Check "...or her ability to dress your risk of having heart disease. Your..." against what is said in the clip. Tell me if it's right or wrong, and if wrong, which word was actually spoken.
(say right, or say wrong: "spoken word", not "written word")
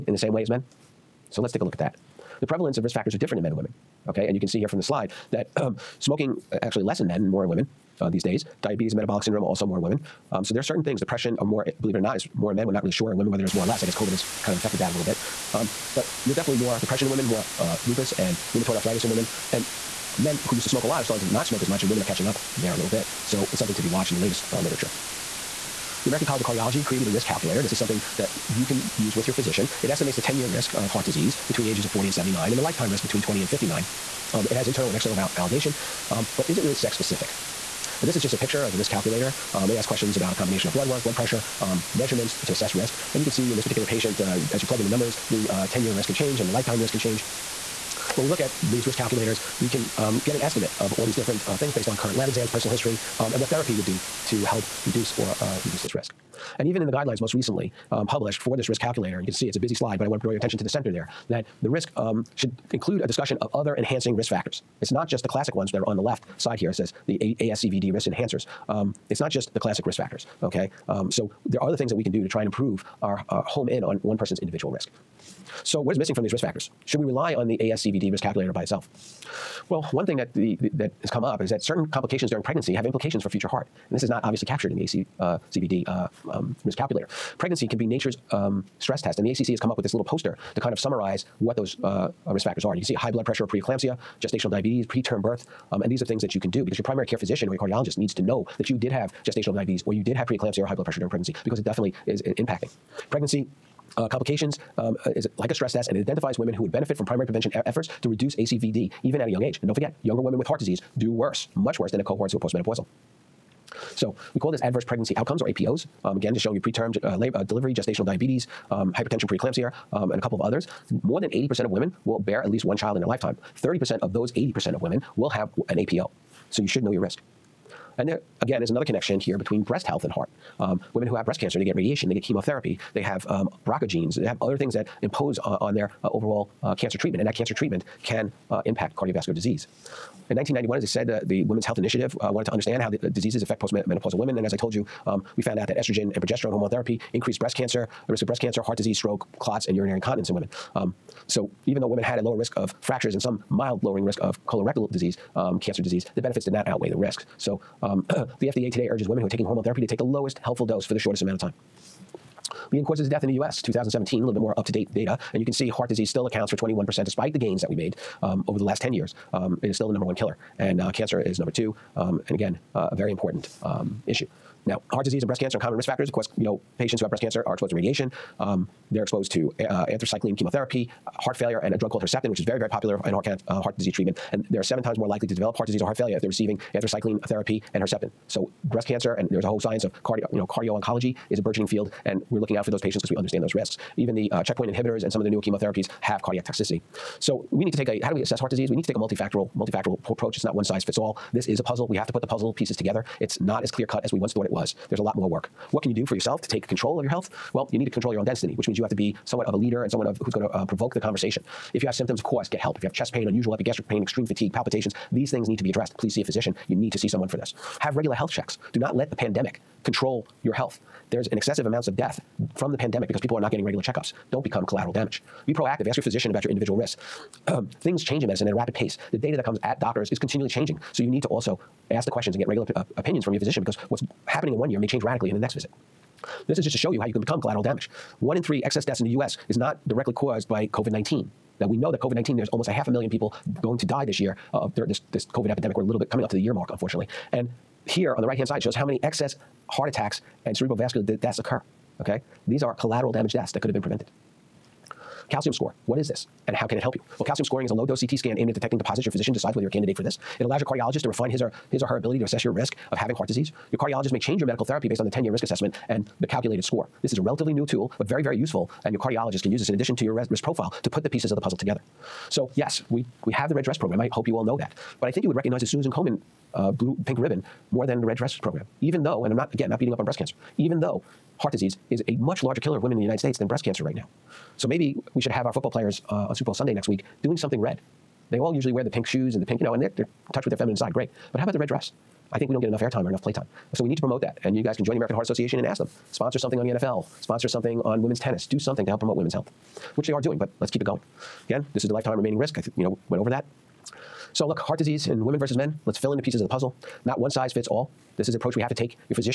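wrong: "assess", not "dress".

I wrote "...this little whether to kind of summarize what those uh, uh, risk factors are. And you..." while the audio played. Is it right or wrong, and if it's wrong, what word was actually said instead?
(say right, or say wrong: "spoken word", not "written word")
wrong: "poster", not "whether".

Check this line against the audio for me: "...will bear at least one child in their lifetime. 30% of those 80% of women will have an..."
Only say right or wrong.
right.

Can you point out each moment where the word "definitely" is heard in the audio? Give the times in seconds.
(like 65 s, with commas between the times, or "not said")
16 s, 101 s.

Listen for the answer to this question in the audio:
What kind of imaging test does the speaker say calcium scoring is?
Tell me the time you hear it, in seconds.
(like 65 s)
257 s.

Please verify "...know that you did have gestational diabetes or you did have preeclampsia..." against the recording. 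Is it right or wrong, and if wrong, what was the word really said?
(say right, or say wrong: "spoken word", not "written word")
right.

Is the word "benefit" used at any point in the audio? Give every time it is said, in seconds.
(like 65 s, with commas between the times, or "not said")
106 s, 156 s.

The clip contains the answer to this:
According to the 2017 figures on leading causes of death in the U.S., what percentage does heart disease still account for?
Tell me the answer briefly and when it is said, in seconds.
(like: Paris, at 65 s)
21%, at 166 s.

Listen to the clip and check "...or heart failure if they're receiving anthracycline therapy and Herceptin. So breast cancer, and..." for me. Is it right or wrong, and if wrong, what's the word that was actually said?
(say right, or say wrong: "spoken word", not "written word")
right.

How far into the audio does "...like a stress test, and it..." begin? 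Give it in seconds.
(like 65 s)
105 s.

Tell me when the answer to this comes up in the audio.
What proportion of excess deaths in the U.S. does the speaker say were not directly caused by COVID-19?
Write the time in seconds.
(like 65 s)
238 s.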